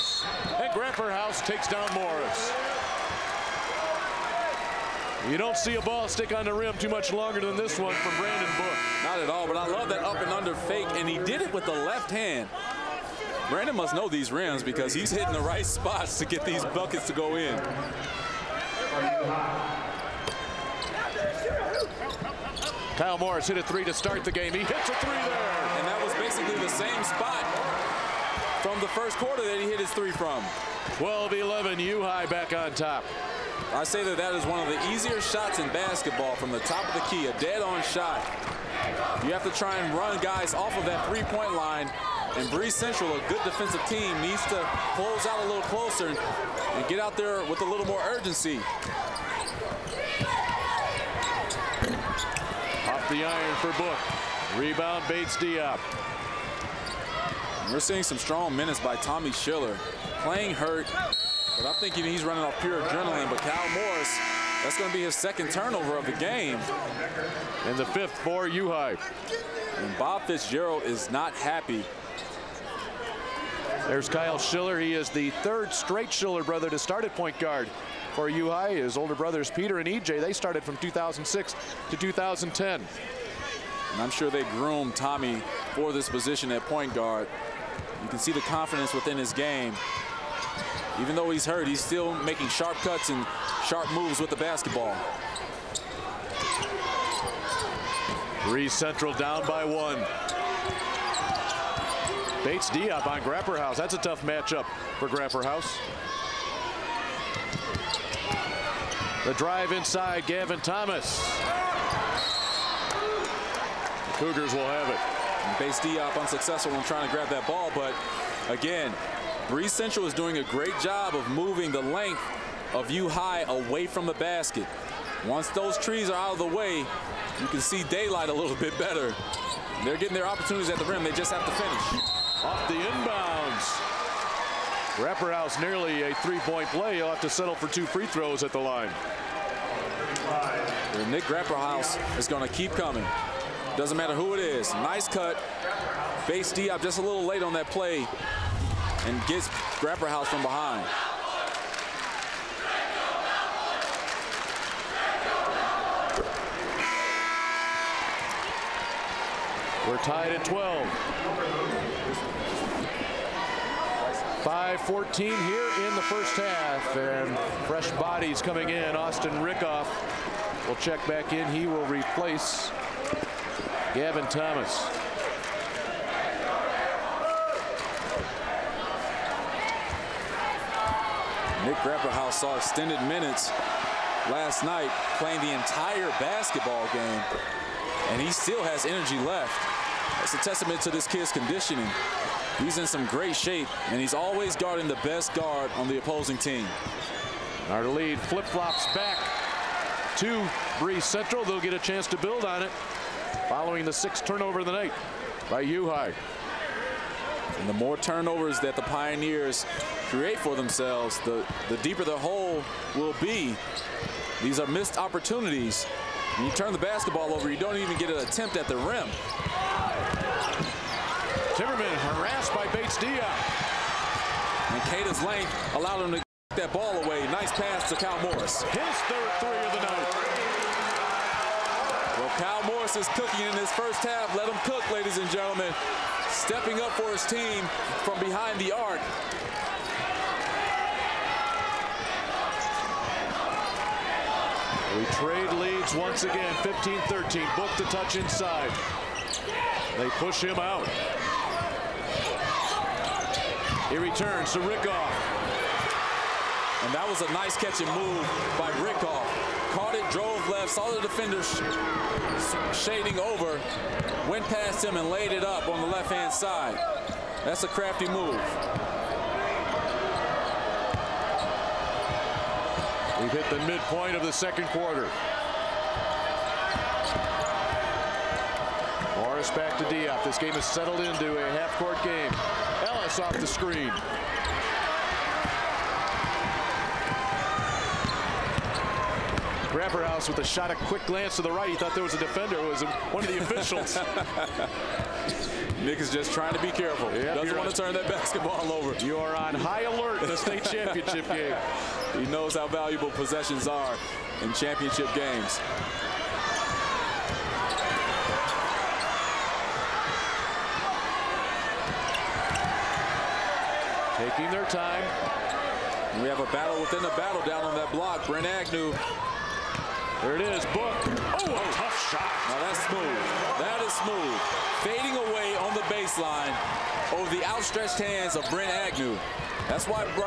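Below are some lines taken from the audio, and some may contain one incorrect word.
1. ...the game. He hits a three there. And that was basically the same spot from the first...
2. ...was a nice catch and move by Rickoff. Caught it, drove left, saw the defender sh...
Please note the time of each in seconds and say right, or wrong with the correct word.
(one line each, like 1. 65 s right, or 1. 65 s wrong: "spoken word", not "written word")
1. 24 s right
2. 257 s right.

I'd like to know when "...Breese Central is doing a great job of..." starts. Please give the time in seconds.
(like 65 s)
119 s.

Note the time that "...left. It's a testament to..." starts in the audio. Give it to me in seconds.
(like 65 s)
189 s.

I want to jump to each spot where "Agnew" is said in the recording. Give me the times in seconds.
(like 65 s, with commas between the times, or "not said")
318 s, 328 s.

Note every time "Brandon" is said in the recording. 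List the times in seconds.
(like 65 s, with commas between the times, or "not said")
8 s, 13 s.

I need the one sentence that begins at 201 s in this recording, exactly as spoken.
They'll get a chance to build on it following the sixth turnover of the night by U High.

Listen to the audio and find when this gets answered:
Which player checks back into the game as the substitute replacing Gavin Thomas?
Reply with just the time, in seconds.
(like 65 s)
168 s.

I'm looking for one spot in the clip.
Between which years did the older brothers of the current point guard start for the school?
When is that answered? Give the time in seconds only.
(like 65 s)
80 s.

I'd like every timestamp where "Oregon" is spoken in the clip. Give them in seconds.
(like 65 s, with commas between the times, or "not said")
not said.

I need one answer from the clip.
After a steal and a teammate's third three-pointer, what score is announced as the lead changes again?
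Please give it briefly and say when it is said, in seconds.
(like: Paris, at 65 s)
15-13, at 246 s.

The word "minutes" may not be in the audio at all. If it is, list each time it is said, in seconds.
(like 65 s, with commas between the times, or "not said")
58 s, 183 s.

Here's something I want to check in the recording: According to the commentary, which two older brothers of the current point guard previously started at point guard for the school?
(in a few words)
Peter and EJ.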